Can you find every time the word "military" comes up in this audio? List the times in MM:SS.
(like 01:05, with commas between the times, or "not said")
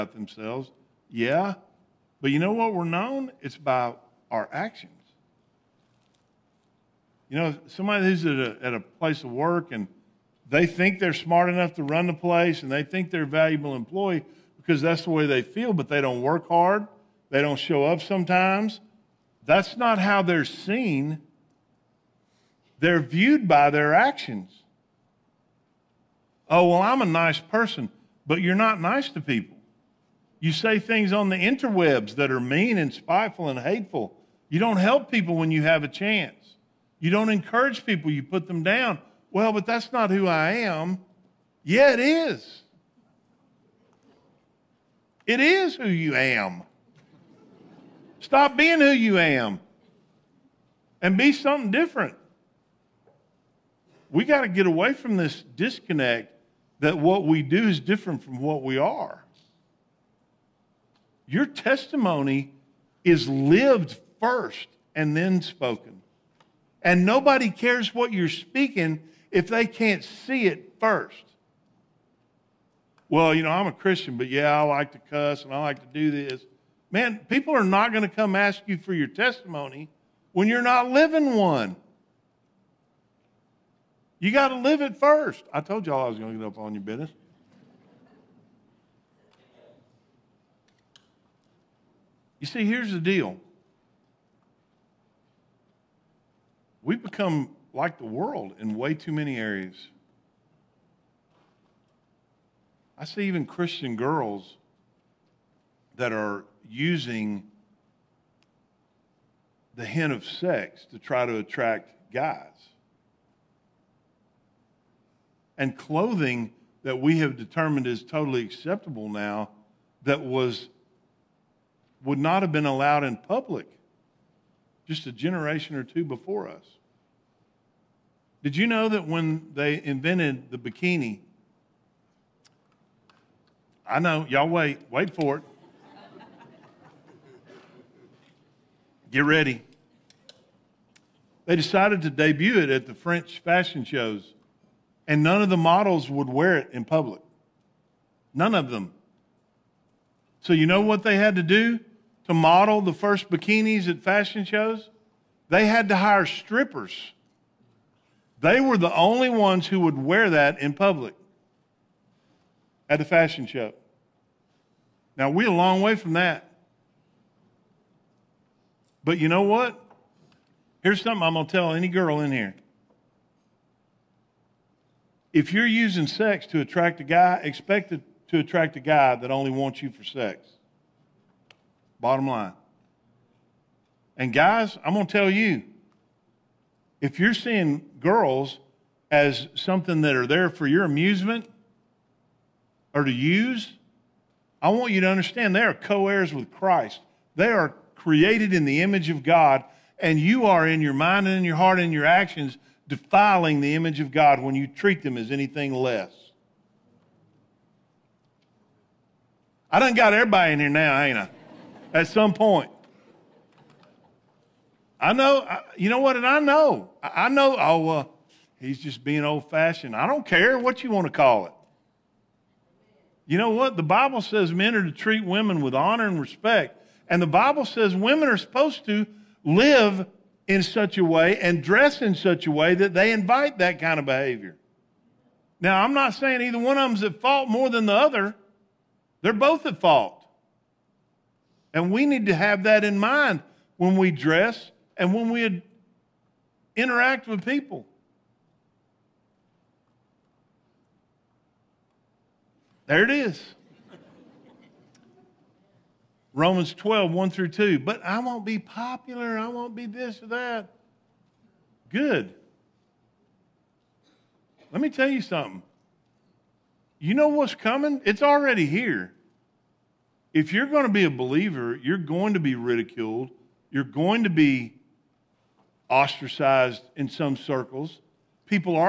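not said.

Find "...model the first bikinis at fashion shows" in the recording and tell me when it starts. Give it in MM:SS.
02:32.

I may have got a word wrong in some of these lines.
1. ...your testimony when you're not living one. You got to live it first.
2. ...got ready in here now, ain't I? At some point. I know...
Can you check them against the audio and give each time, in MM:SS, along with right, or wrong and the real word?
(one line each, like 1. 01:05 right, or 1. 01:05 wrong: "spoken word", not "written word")
1. 01:18 right
2. 03:29 wrong: "everybody", not "ready".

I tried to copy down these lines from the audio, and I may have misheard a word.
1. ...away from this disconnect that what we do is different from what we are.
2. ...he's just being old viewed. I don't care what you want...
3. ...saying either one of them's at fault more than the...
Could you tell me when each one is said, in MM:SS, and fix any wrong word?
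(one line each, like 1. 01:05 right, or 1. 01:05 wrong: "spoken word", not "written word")
1. 00:54 right
2. 03:38 wrong: "fashioned", not "viewed"
3. 03:56 right.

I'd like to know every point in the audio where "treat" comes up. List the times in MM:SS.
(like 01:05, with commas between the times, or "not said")
03:24, 03:44.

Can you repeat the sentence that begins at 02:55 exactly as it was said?
If you're using sex to attract a guy, expect to attract a guy that only wants you for sex.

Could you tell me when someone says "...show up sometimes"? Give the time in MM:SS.
00:17.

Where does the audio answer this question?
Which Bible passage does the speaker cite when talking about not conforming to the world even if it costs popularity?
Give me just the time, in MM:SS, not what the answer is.
04:16.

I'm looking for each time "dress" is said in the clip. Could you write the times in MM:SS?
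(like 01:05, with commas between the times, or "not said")
03:51, 04:04.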